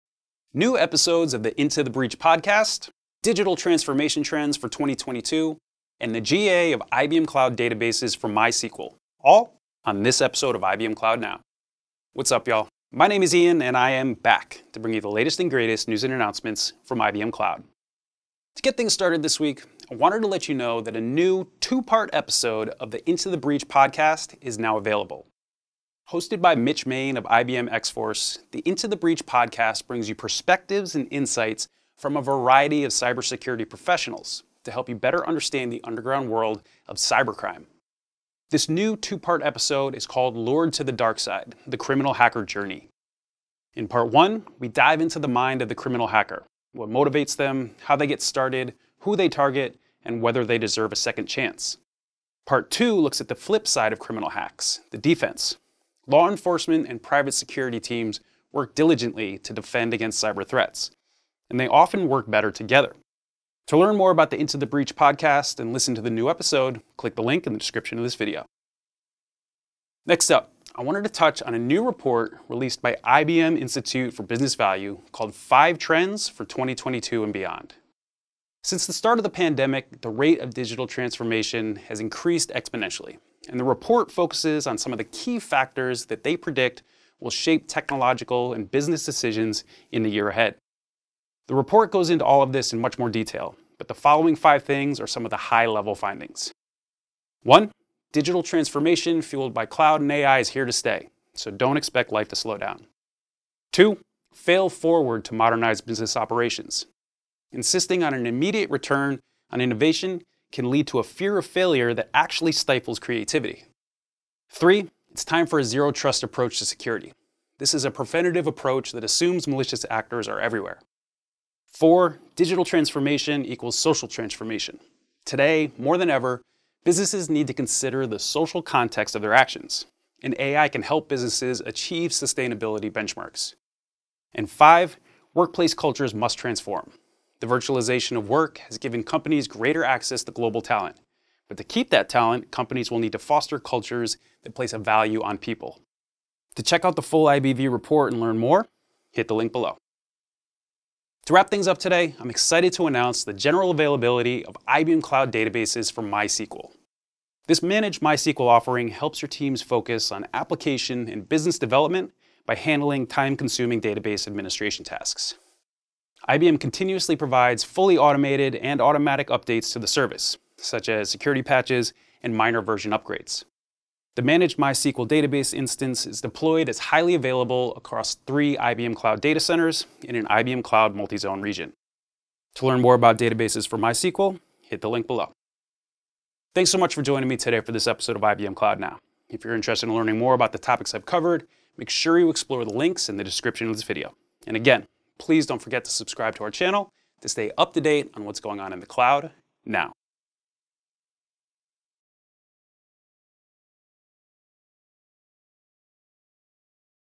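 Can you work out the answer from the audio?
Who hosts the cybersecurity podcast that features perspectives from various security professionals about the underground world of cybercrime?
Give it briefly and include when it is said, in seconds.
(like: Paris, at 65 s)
Mitch Mayne, at 26 s.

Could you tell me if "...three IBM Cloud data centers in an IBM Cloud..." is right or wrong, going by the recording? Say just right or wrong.
right.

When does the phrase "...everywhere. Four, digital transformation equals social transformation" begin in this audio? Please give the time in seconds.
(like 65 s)
120 s.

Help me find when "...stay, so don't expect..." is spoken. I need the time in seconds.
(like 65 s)
100 s.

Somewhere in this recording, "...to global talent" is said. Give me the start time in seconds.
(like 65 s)
140 s.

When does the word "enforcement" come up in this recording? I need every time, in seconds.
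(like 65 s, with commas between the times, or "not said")
56 s.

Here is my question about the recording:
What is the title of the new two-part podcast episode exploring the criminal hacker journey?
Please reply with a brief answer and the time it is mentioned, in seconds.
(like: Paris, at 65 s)
Lured to the Dark Side, at 40 s.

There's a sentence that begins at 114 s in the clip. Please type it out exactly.
Three, it's time for a zero trust approach to security.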